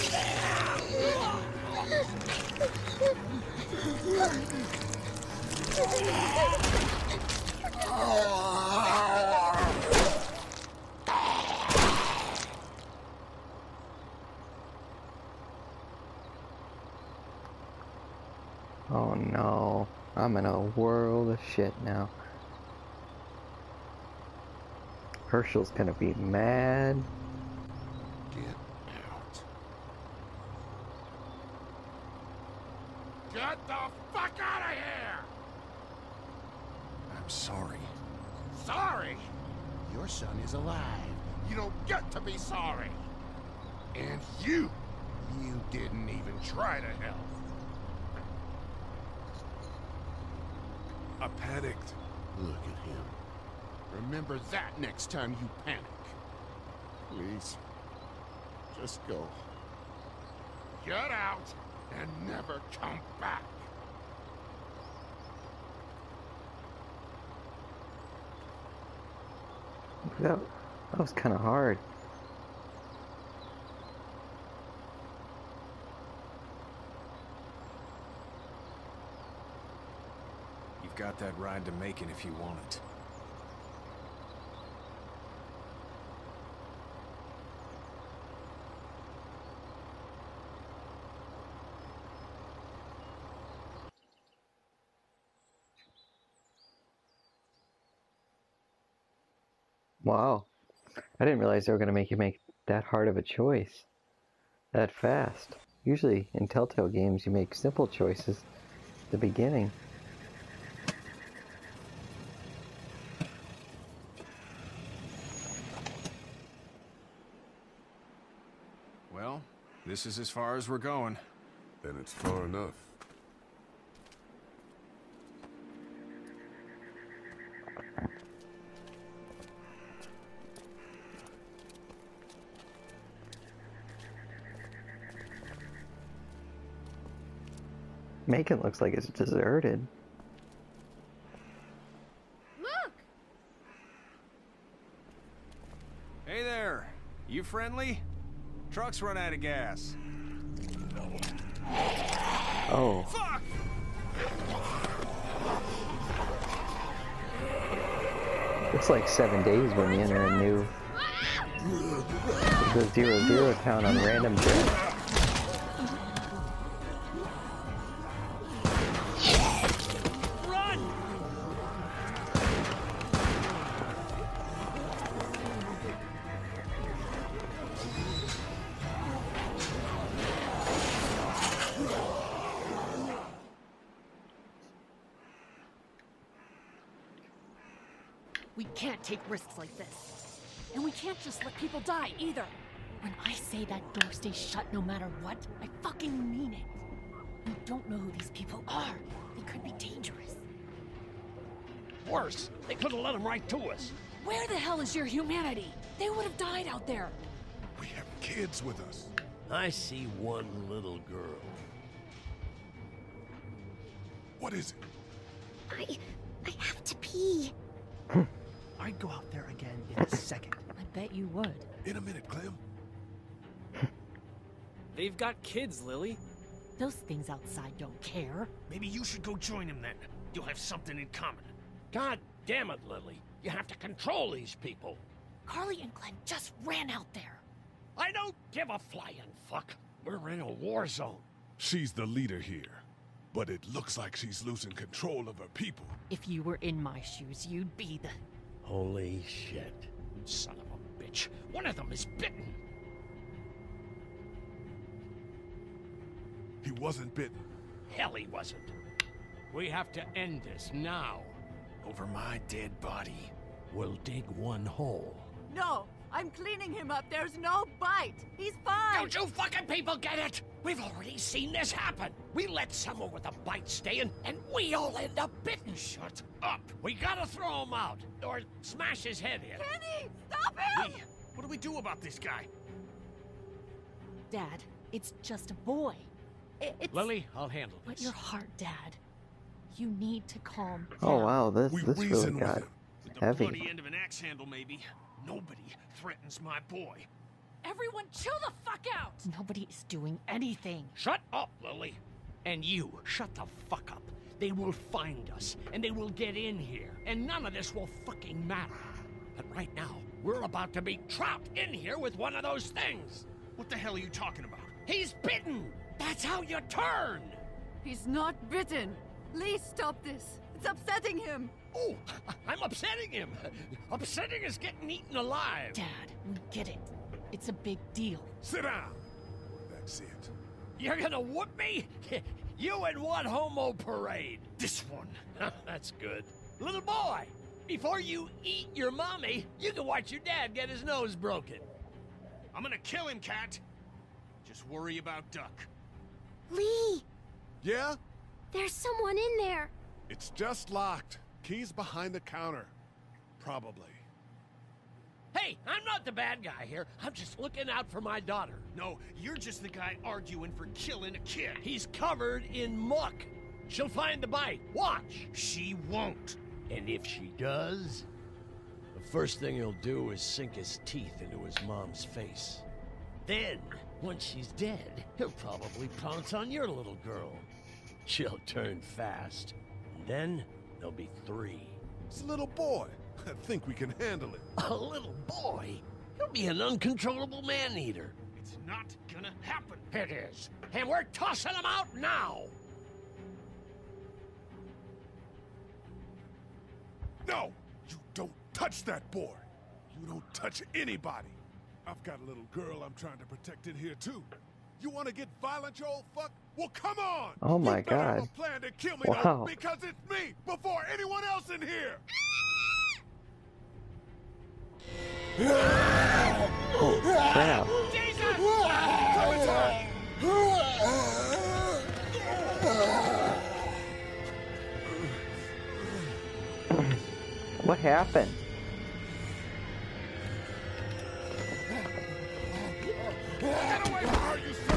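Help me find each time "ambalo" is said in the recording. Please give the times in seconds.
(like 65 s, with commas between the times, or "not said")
not said.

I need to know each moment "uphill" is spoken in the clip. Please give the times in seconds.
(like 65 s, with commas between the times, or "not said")
not said.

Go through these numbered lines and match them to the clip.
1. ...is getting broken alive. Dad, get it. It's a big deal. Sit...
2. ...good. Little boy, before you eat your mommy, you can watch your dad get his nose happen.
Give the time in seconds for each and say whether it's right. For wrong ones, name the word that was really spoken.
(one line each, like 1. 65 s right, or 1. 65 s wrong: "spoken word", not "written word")
1. 324 s wrong: "eaten", not "broken"
2. 335 s wrong: "broken", not "happen".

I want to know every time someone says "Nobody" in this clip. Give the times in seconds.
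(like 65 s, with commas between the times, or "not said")
295 s, 299 s.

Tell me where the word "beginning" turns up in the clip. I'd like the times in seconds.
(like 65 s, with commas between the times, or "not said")
109 s.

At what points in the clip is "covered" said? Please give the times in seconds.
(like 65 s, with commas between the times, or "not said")
361 s.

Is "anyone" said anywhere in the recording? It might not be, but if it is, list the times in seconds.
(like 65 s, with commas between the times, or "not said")
410 s.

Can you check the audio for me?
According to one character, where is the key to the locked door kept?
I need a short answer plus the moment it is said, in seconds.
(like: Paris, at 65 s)
Behind the counter, at 351 s.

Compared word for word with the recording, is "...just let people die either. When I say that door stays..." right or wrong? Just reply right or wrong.
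right.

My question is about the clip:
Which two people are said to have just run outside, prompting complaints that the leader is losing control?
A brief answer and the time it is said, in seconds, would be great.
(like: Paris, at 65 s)
Carly and Glenn, at 235 s.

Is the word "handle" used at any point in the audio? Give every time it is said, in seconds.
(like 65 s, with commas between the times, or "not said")
287 s, 294 s, 383 s.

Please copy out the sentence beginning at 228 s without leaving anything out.
Maybe you should go join them then.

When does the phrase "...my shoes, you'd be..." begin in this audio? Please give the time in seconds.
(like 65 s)
246 s.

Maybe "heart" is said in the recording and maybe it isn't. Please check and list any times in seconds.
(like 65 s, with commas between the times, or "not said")
288 s.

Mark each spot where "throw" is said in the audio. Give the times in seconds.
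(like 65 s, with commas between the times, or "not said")
277 s.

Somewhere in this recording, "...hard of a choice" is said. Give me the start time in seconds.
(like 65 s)
102 s.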